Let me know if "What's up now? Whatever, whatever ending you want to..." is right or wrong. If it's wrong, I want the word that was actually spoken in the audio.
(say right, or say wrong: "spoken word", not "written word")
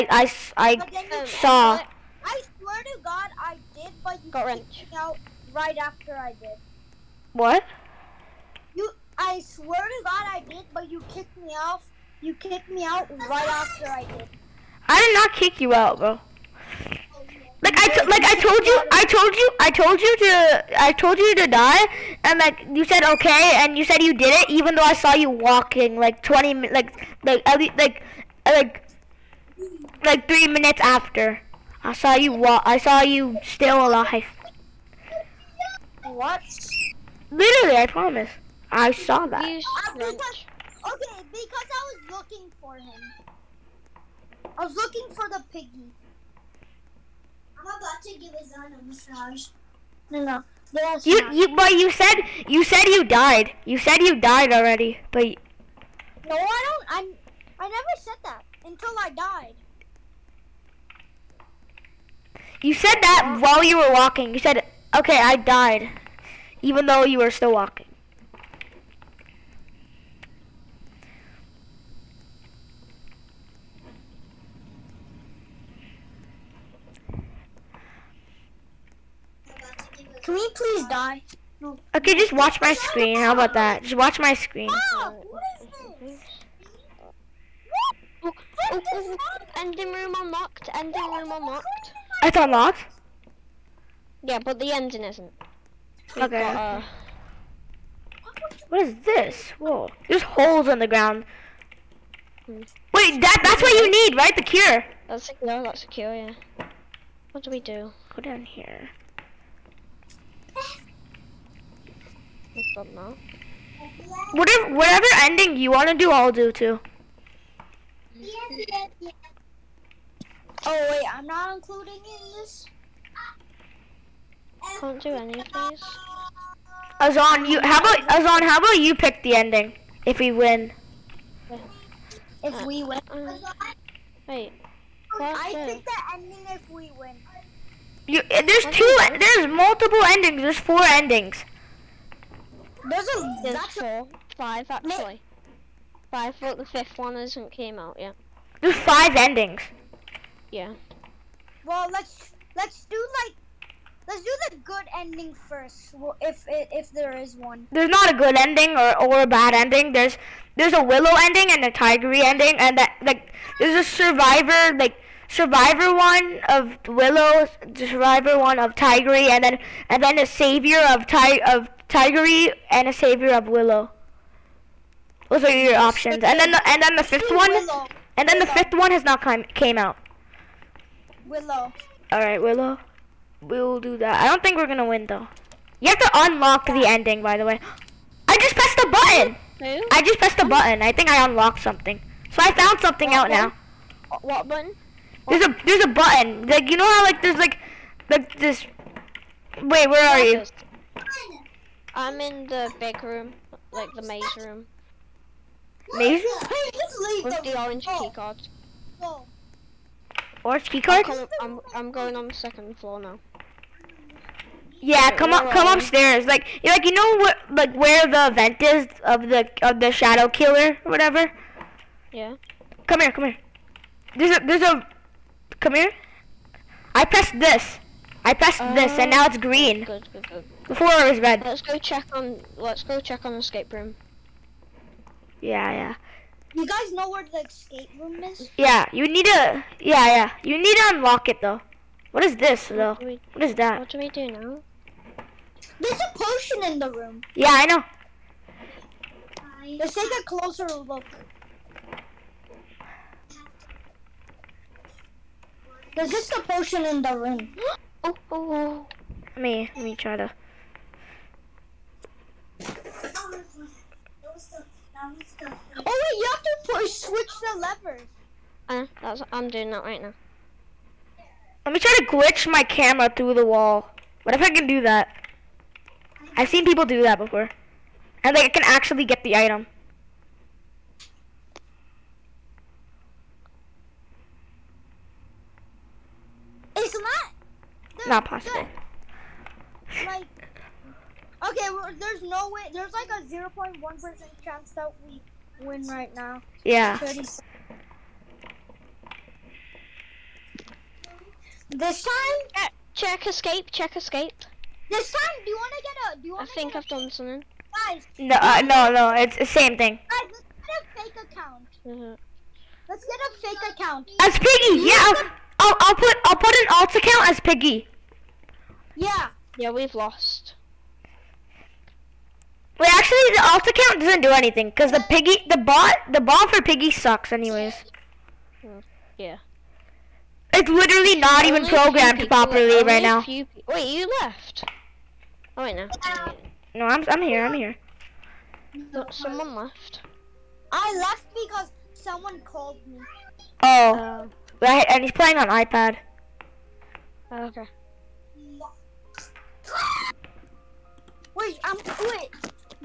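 right.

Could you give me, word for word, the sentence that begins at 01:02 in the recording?
You said that while you were walking.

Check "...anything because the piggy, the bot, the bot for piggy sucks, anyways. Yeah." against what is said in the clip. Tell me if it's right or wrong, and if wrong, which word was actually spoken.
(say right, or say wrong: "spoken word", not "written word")
right.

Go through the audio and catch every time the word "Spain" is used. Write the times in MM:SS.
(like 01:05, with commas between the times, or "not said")
not said.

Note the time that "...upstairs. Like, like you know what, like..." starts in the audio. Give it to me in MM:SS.
03:35.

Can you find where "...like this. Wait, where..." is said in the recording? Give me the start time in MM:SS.
03:18.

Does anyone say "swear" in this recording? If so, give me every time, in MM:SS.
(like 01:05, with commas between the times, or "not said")
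00:02, 00:09.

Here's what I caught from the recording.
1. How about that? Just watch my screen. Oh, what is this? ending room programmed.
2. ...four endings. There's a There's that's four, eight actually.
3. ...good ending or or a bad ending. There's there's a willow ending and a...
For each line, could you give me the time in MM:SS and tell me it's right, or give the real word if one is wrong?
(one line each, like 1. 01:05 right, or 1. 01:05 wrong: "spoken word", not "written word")
1. 01:23 wrong: "unlocked", not "programmed"
2. 02:20 wrong: "five", not "eight"
3. 02:38 right.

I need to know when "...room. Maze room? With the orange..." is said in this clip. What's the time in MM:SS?
03:24.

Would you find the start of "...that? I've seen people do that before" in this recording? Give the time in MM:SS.
04:34.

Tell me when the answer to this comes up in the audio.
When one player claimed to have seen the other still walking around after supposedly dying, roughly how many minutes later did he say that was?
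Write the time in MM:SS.
00:30.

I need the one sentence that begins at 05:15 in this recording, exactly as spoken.
I'll, I'll put I'll put an alt account as Piggy.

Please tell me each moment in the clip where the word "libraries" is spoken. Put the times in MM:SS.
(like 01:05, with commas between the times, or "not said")
not said.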